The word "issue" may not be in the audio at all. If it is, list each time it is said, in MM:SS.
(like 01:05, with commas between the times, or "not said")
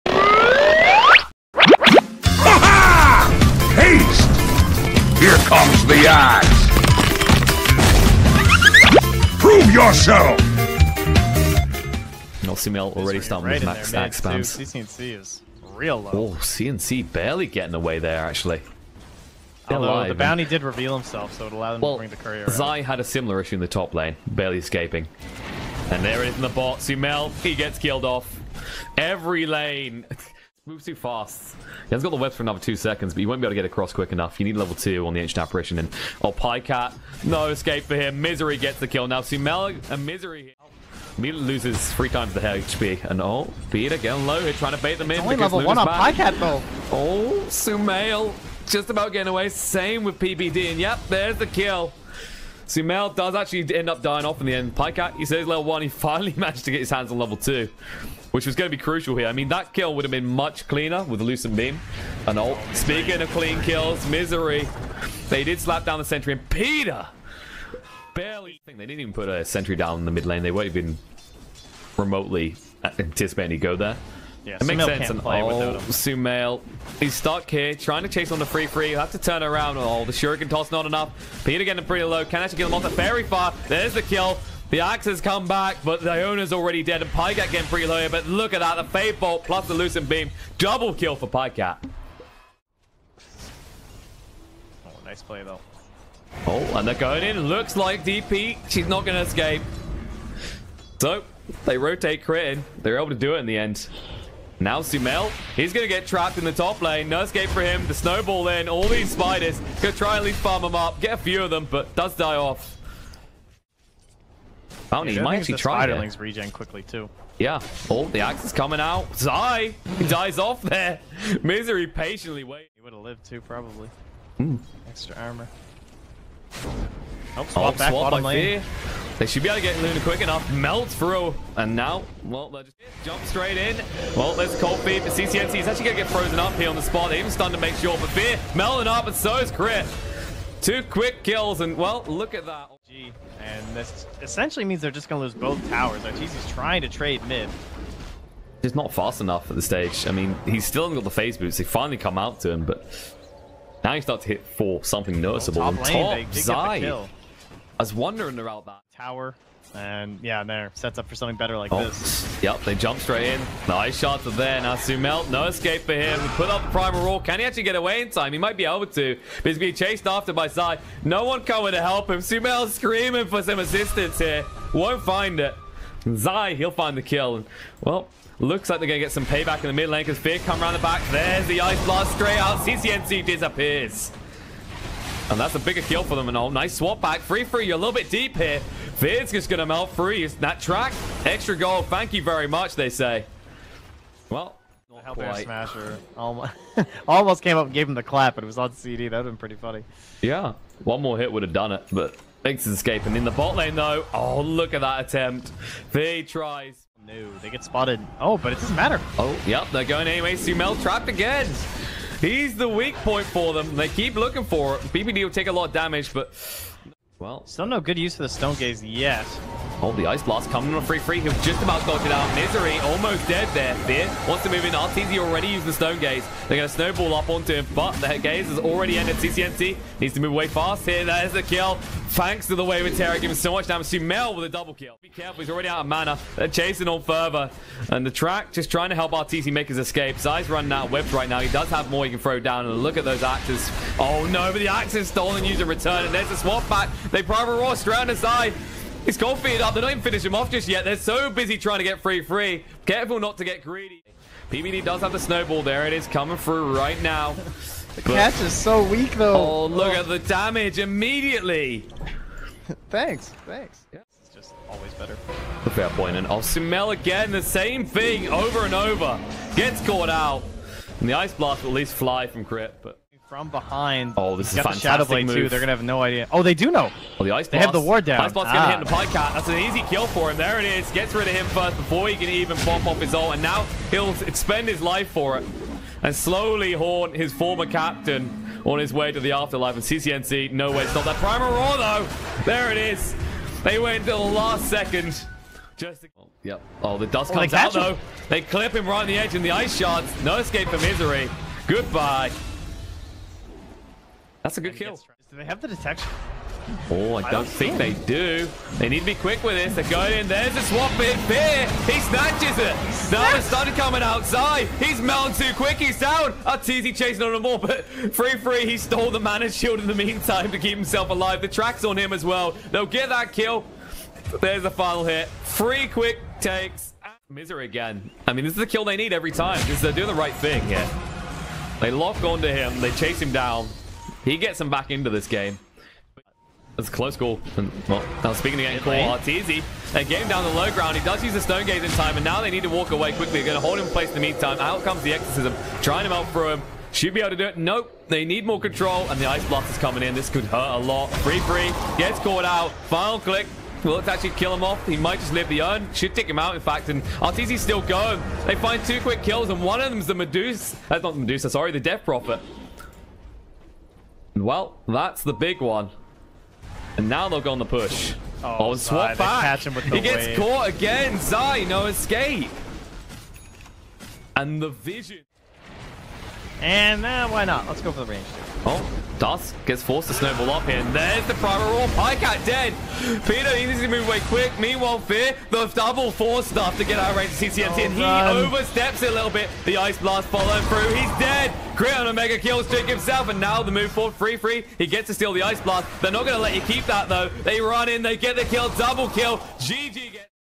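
00:23.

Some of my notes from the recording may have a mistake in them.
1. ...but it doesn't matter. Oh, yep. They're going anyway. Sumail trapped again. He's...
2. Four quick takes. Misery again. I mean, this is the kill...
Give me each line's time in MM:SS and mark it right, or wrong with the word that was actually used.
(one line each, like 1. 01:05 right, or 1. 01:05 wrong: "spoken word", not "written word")
1. 03:28 right
2. 05:25 wrong: "Three", not "Four".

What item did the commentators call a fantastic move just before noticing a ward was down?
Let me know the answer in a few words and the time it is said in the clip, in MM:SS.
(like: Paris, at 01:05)
Shadow Blade, at 04:34.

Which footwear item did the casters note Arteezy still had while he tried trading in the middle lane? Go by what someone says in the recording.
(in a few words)
phase boots.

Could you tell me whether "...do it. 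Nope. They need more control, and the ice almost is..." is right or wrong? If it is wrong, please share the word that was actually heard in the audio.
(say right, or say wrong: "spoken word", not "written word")
wrong: "blast", not "almost".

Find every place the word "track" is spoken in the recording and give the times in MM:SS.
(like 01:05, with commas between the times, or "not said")
03:10, 03:58, 05:21.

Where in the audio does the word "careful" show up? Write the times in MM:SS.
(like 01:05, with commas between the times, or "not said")
03:55, 04:12.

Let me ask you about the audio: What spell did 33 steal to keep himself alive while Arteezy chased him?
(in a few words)
mana shield.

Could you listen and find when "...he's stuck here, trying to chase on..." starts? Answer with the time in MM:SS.
01:16.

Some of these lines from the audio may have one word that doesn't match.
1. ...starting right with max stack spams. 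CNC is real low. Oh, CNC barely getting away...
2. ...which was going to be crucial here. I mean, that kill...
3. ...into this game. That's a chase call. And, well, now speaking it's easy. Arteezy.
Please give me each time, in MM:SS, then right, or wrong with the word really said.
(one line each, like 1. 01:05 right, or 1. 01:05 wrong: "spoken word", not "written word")
1. 00:13 right
2. 00:58 right
3. 05:34 wrong: "close", not "chase".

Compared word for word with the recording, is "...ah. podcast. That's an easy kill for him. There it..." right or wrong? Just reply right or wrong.
right.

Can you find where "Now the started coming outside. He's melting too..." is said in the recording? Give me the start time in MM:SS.
05:13.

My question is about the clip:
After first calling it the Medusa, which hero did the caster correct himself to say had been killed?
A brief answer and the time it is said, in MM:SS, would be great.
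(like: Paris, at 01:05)
Death Prophet, at 06:01.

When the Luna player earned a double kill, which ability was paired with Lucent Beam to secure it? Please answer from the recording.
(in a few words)
Fade Bolt.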